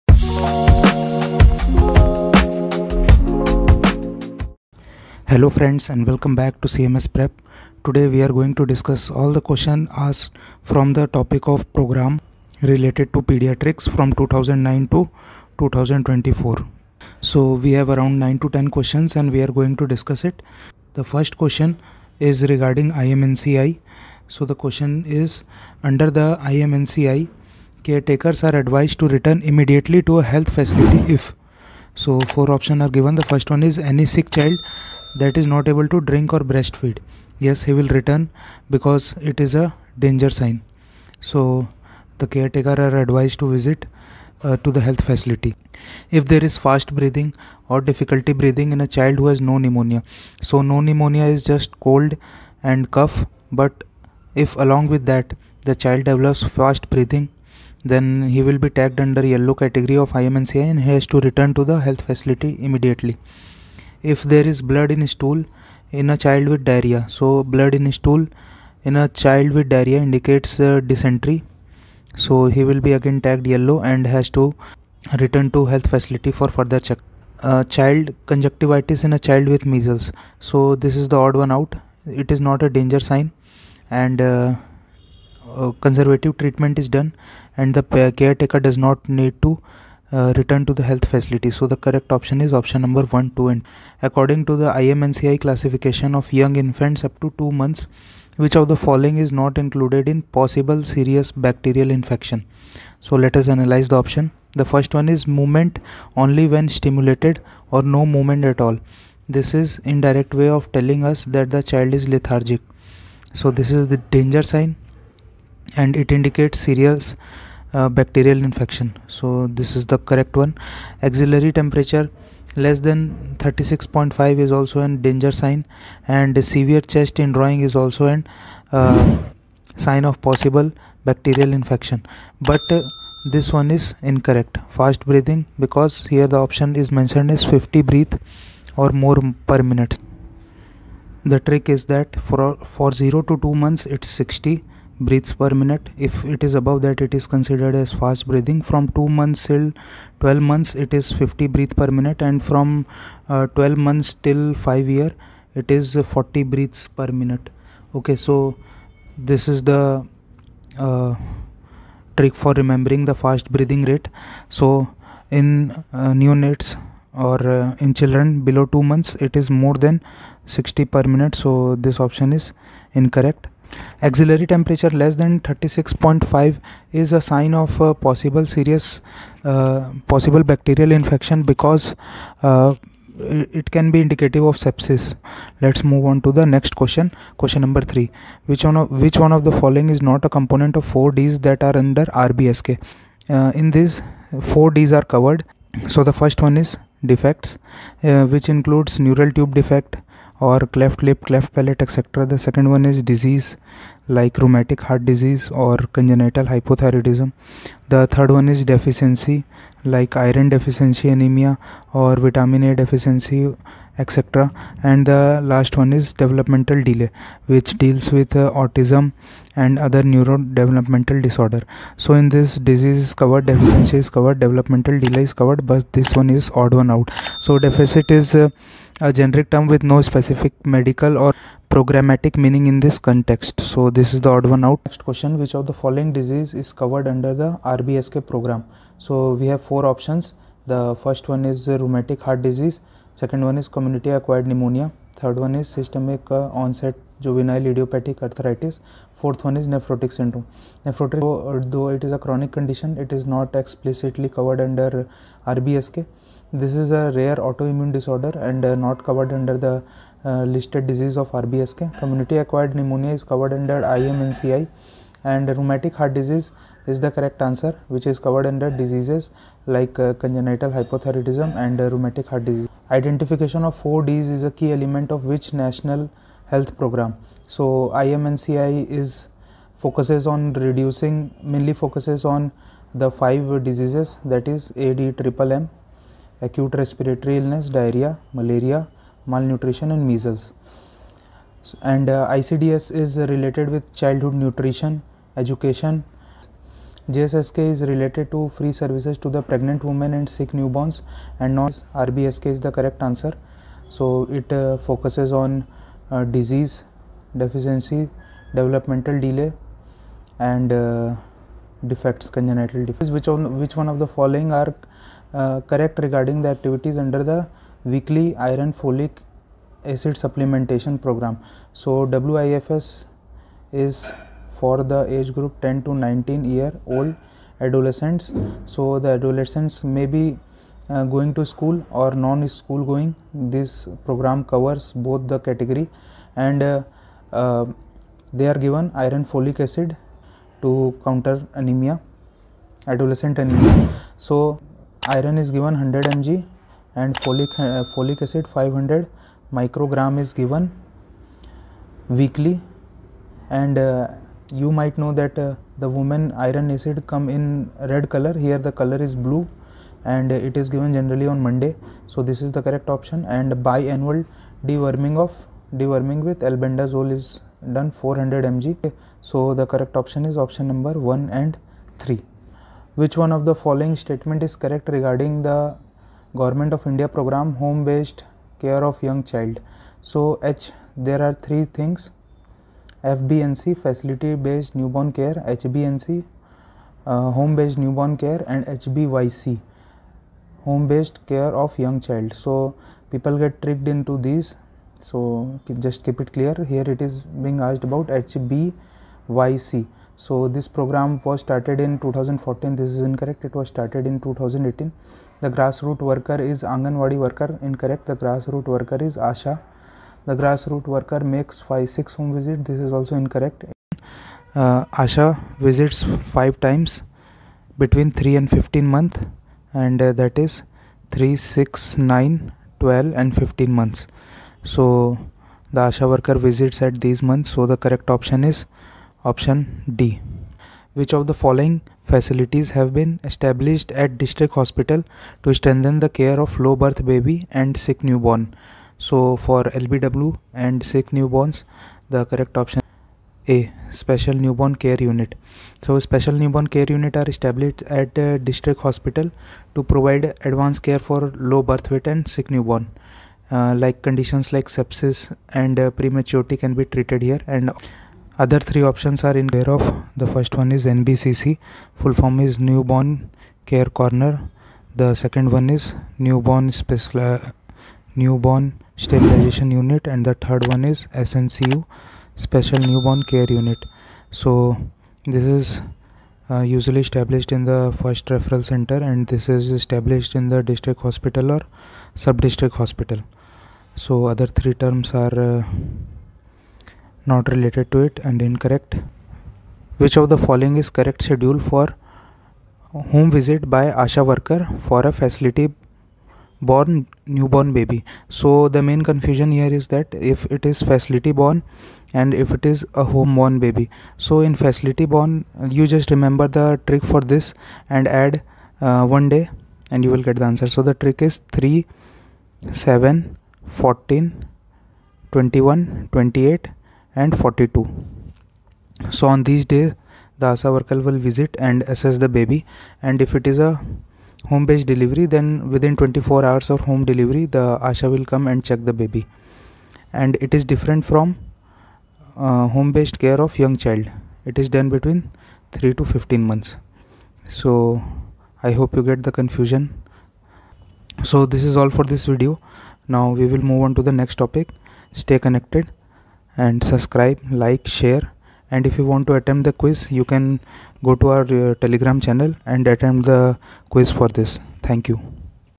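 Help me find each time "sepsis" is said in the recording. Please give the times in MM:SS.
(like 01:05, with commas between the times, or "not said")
03:04, 07:34.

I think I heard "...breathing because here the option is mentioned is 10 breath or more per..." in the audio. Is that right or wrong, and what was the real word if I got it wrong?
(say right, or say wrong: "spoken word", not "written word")
wrong: "50", not "10".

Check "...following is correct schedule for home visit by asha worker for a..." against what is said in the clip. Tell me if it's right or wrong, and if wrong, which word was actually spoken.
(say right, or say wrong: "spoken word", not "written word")
right.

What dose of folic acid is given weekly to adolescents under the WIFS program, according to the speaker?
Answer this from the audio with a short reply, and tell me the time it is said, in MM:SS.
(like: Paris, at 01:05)
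500 micrograms, at 05:48.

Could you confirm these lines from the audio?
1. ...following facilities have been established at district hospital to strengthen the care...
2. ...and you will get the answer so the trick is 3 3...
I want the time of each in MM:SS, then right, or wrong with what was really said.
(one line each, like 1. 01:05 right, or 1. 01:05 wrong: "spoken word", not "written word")
1. 07:11 right
2. 08:29 wrong: "7", not "3".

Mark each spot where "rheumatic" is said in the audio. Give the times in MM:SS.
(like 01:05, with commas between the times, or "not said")
04:01, 04:25, 04:31.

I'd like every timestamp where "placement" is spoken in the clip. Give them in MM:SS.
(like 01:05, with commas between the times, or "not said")
not said.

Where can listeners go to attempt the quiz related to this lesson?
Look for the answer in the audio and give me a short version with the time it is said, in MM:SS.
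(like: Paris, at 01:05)
Telegram channel, at 09:11.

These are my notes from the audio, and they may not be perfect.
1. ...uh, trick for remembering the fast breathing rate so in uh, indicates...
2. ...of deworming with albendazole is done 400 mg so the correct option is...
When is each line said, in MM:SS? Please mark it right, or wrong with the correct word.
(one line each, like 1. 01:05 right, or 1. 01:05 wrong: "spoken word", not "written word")
1. 02:40 wrong: "neonates", not "indicates"
2. 06:05 right.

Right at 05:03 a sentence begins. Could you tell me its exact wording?
So it uh, focuses on uh, disease, deficiency, developmental delay and uh, defects, congenital defects.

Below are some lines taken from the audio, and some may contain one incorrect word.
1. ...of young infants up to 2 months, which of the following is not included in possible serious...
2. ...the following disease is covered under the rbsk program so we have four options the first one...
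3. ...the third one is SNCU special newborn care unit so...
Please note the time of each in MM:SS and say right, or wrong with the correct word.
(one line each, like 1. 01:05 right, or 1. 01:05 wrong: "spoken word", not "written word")
1. 01:36 right
2. 03:55 right
3. 07:50 right.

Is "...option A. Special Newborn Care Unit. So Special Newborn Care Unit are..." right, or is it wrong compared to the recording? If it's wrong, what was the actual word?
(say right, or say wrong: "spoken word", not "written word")
right.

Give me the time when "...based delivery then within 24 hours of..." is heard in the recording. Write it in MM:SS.
08:44.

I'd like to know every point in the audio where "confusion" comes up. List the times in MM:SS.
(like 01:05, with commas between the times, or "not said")
08:19, 08:59.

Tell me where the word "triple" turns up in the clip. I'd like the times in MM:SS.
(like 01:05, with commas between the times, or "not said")
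04:45.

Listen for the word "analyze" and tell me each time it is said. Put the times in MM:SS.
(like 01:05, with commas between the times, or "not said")
01:43.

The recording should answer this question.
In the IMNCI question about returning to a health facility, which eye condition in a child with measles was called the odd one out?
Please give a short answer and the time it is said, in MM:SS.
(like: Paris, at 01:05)
Conjunctivitis, at 01:18.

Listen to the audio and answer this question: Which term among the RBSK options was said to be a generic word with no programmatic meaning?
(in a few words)
Deficit.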